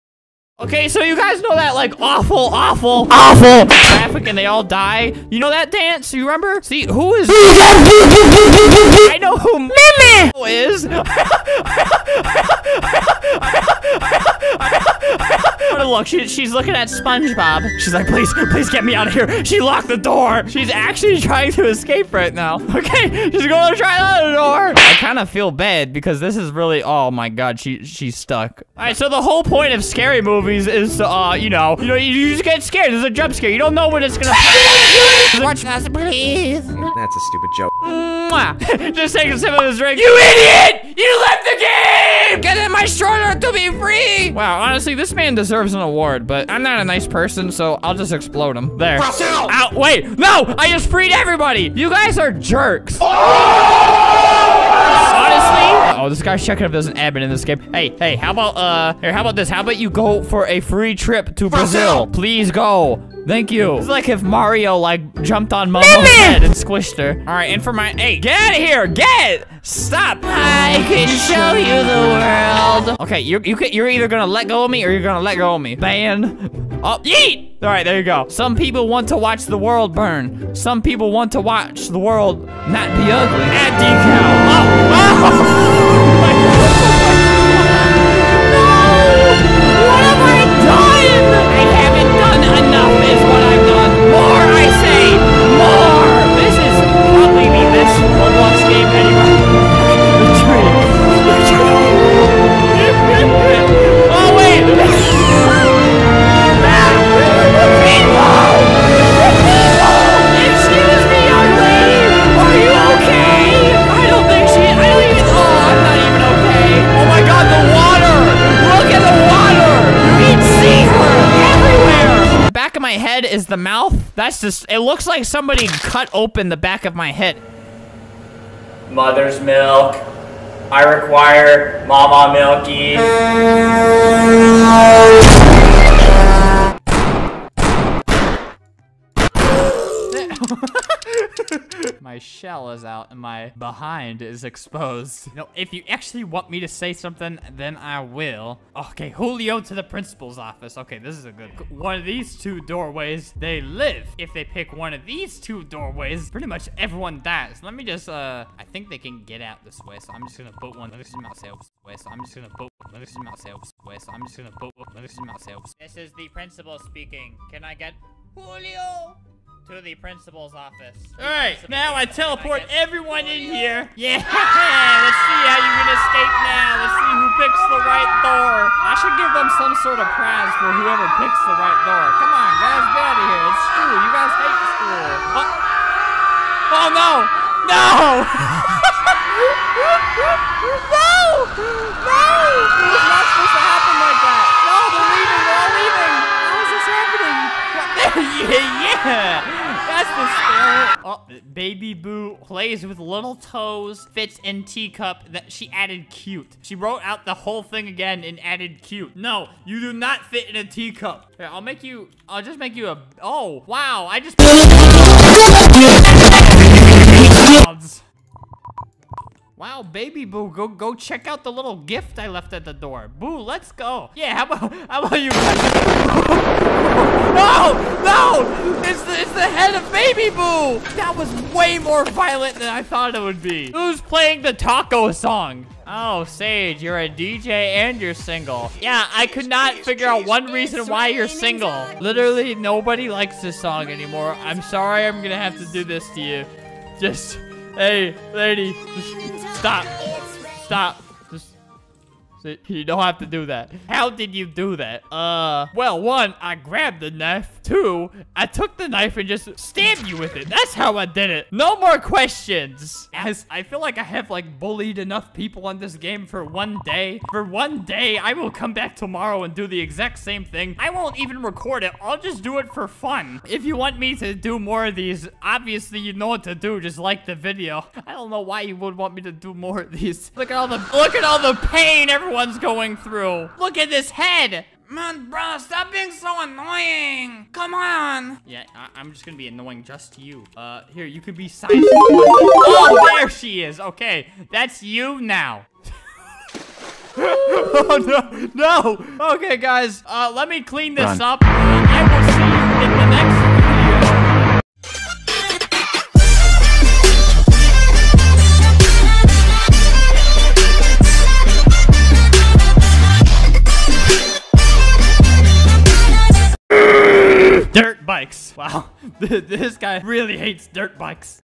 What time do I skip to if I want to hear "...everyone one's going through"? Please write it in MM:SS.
04:42.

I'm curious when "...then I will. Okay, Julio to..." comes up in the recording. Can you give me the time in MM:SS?
02:27.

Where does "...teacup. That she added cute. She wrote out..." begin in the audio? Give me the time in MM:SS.
03:24.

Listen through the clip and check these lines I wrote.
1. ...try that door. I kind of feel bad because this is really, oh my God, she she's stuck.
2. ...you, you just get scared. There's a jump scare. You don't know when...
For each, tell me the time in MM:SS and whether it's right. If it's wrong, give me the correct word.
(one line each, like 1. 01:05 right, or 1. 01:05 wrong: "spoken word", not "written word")
1. 00:23 right
2. 00:31 right.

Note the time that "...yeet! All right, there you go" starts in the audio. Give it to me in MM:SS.
01:17.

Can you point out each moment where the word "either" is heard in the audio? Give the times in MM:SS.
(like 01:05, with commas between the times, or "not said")
01:13.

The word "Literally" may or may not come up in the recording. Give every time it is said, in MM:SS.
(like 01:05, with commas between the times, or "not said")
04:01.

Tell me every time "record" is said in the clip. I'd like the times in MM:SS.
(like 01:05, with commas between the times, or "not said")
04:31.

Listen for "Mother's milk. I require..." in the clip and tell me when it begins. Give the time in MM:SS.
02:08.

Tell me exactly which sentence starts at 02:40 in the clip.
This is myself way, so I'm just gonna put one.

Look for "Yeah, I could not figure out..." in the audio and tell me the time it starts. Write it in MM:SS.
03:58.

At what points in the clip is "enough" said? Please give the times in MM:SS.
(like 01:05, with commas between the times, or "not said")
04:24.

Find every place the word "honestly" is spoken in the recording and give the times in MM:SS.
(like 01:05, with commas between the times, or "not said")
00:44, 00:55.